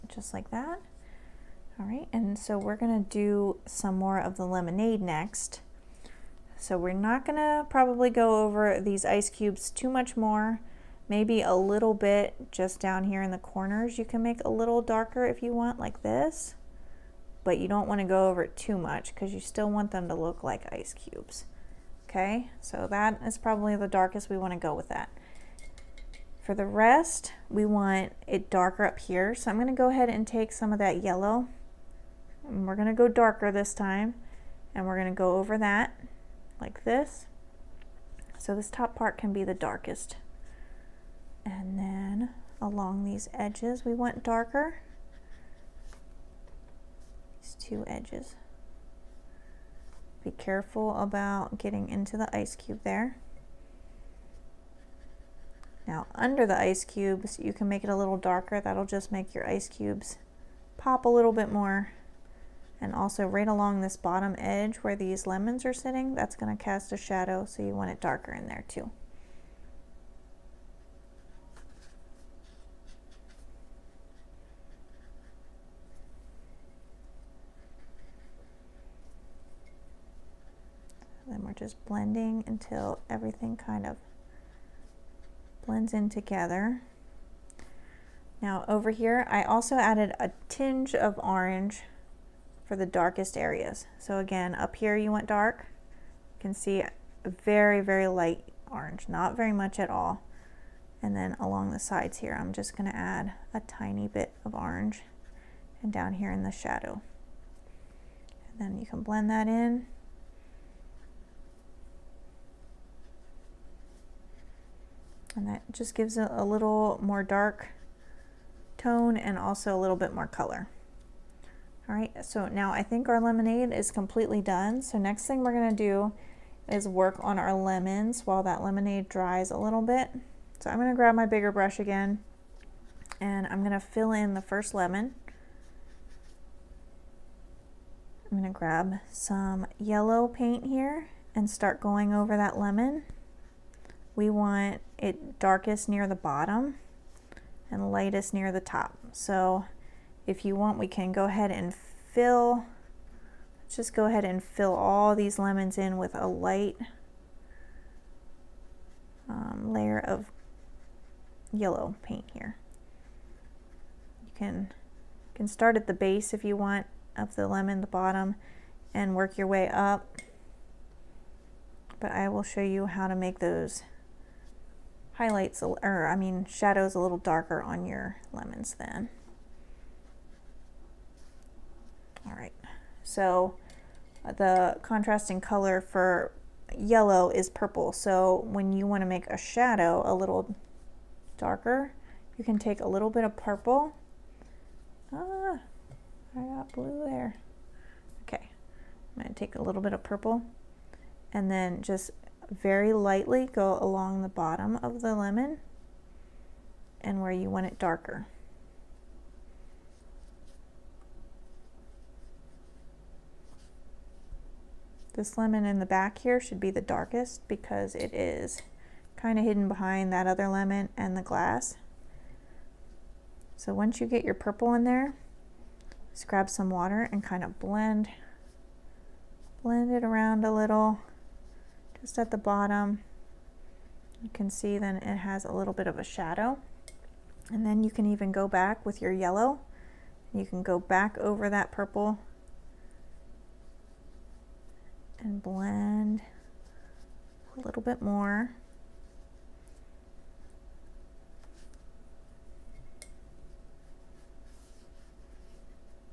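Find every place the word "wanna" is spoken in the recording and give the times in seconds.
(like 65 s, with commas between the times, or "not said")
17 s, 24 s, 188 s.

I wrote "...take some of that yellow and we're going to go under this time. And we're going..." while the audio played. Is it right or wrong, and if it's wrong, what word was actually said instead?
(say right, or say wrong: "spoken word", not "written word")
wrong: "darker", not "under".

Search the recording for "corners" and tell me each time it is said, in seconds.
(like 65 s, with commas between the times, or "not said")
13 s.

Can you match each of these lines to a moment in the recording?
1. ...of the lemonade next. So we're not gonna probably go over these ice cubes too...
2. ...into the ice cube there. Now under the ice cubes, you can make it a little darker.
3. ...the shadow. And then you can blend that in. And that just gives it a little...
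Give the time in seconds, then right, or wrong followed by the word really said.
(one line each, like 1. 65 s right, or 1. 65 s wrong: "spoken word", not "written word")
1. 4 s right
2. 51 s right
3. 106 s right.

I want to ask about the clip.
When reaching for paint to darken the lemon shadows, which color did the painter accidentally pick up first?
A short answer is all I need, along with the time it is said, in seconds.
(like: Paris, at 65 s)
blue, at 196 s.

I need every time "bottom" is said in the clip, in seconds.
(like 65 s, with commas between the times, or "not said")
63 s, 146 s, 167 s, 204 s, 232 s.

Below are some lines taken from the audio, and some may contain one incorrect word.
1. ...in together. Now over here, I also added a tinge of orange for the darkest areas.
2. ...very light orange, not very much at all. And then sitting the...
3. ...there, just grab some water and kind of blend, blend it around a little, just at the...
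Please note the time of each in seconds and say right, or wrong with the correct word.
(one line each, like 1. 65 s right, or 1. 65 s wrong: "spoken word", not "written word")
1. 85 s right
2. 97 s wrong: "along", not "sitting"
3. 224 s right.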